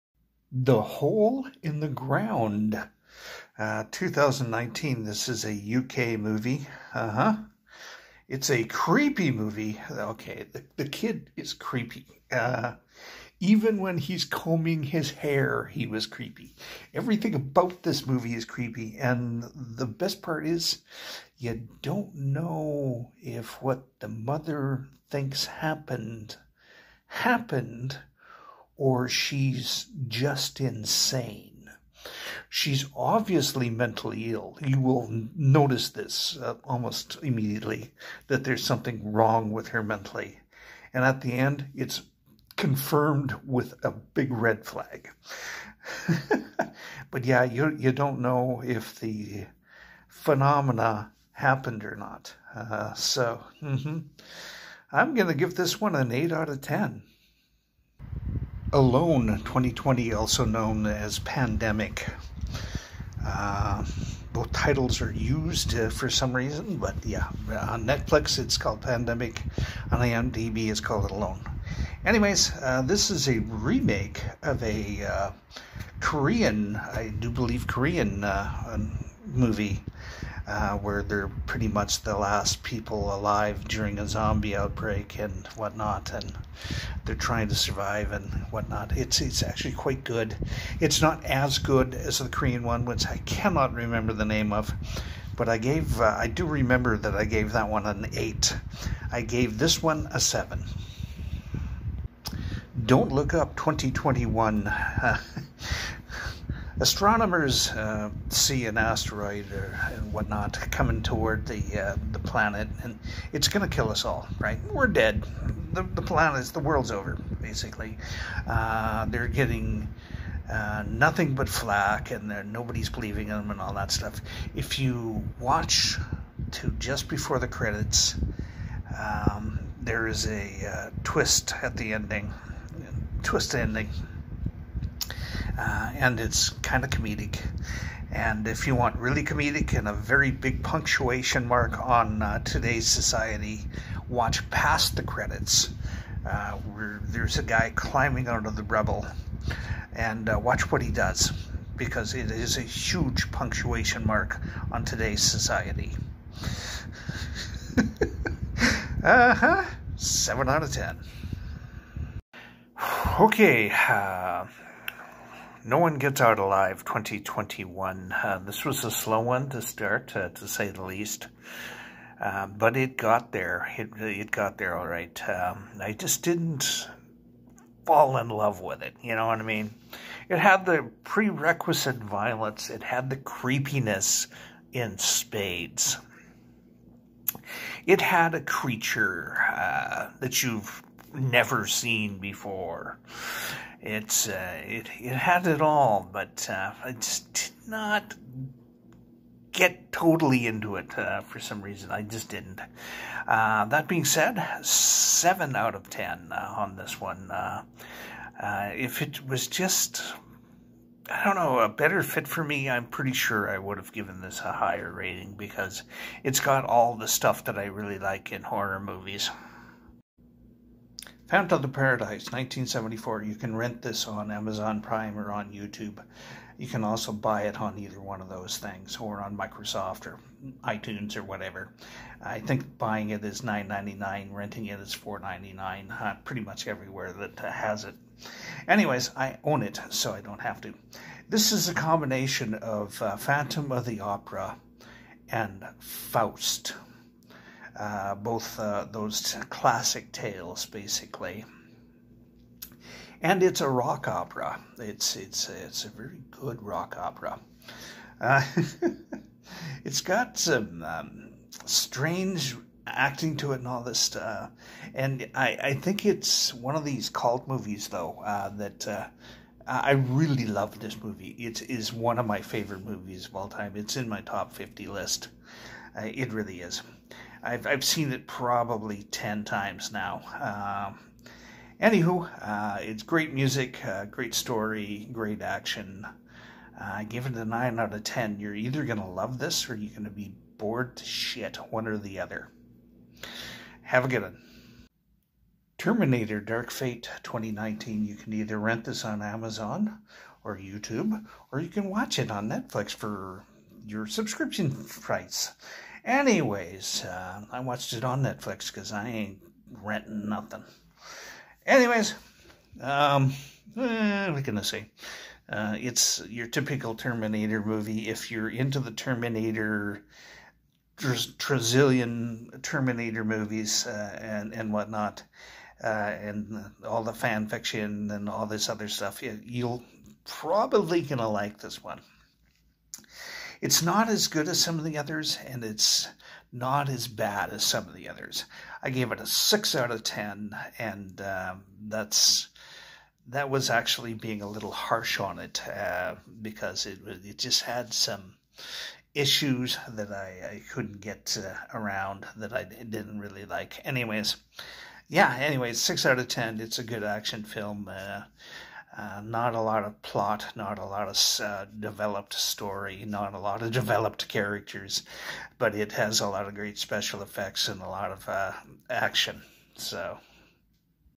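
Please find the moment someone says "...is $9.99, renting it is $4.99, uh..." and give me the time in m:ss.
3:53.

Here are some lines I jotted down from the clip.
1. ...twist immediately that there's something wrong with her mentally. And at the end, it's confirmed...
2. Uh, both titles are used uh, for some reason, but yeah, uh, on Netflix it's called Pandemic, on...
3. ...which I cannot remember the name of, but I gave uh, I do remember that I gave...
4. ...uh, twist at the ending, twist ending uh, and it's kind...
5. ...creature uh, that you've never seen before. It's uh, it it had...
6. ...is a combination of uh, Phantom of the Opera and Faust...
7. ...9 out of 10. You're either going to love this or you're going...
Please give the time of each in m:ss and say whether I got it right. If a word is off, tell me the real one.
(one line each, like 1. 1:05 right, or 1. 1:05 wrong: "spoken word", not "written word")
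1. 0:36 wrong: "almost", not "twist"
2. 1:03 right
3. 1:32 right
4. 2:10 right
5. 3:08 right
6. 4:01 right
7. 4:47 right.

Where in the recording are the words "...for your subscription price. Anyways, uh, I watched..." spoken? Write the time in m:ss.
5:02.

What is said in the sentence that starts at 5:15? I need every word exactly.
Uh, it's your typical Terminator movie.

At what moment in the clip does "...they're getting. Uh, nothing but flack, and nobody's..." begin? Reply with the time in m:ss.
1:59.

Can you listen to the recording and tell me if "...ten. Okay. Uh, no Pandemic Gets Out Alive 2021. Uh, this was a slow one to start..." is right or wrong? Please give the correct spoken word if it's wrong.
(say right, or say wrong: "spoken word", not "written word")
wrong: "One", not "Pandemic".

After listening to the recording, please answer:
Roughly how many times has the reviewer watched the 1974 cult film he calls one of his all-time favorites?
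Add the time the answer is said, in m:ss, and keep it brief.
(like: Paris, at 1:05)
10, at 4:39.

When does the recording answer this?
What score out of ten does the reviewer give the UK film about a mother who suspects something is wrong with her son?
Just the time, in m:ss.
0:56.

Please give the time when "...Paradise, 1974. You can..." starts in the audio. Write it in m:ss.
3:41.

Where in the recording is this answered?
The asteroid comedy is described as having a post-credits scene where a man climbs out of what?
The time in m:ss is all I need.
2:28.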